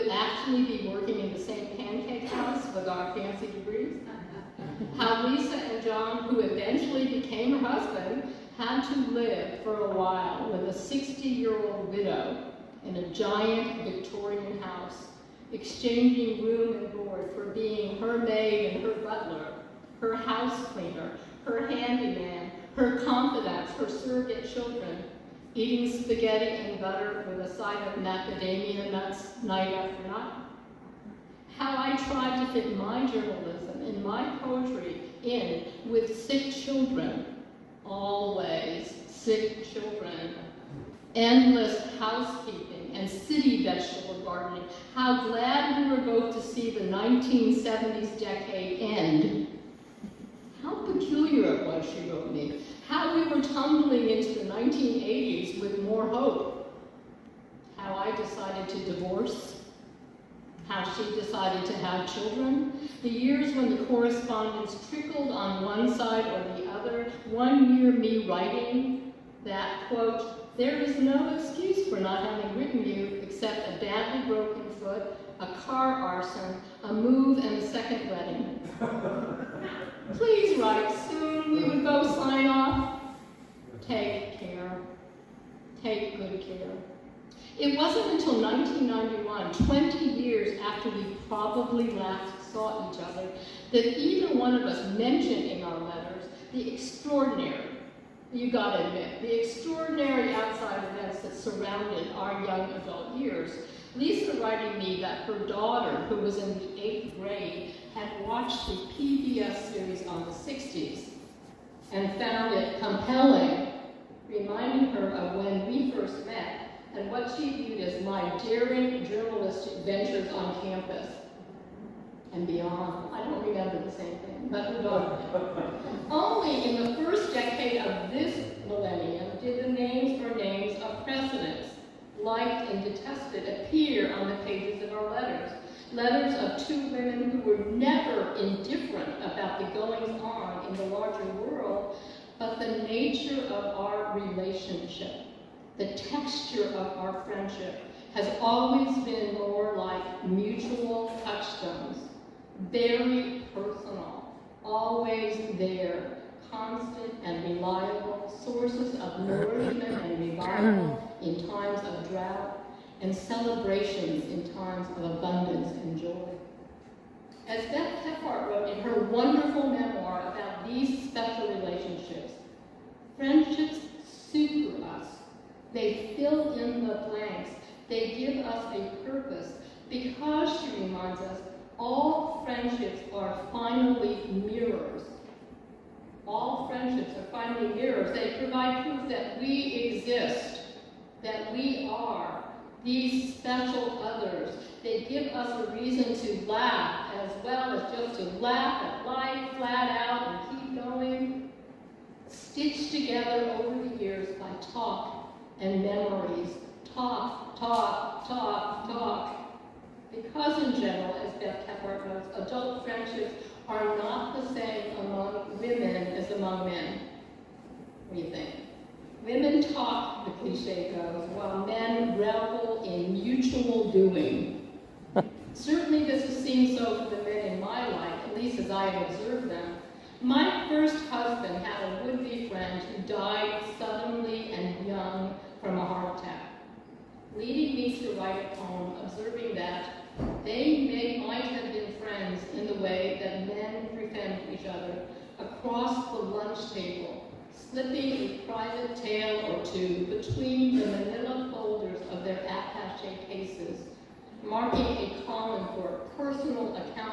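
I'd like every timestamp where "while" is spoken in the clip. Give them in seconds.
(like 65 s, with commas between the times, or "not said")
9 s, 221 s.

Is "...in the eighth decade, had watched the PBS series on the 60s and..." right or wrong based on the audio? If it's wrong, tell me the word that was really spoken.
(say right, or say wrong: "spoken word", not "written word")
wrong: "grade", not "decade".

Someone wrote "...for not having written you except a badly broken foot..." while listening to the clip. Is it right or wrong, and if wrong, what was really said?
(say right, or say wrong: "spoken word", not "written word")
right.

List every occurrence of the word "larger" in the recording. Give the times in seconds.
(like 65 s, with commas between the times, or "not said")
140 s.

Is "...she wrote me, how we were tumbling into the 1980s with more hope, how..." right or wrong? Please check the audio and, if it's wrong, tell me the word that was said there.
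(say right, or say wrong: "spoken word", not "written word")
right.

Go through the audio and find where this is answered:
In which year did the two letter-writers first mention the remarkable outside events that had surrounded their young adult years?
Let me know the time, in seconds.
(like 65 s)
88 s.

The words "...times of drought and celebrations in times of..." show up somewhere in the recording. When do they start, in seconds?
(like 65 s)
161 s.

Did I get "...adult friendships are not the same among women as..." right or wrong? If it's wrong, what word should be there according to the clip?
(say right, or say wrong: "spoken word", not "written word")
right.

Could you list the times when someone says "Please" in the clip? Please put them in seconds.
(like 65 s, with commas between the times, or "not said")
80 s.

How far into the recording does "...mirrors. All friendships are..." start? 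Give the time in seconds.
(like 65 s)
184 s.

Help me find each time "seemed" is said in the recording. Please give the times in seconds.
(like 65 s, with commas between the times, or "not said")
226 s.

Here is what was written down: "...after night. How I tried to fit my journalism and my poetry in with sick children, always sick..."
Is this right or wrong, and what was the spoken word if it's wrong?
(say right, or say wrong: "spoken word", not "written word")
right.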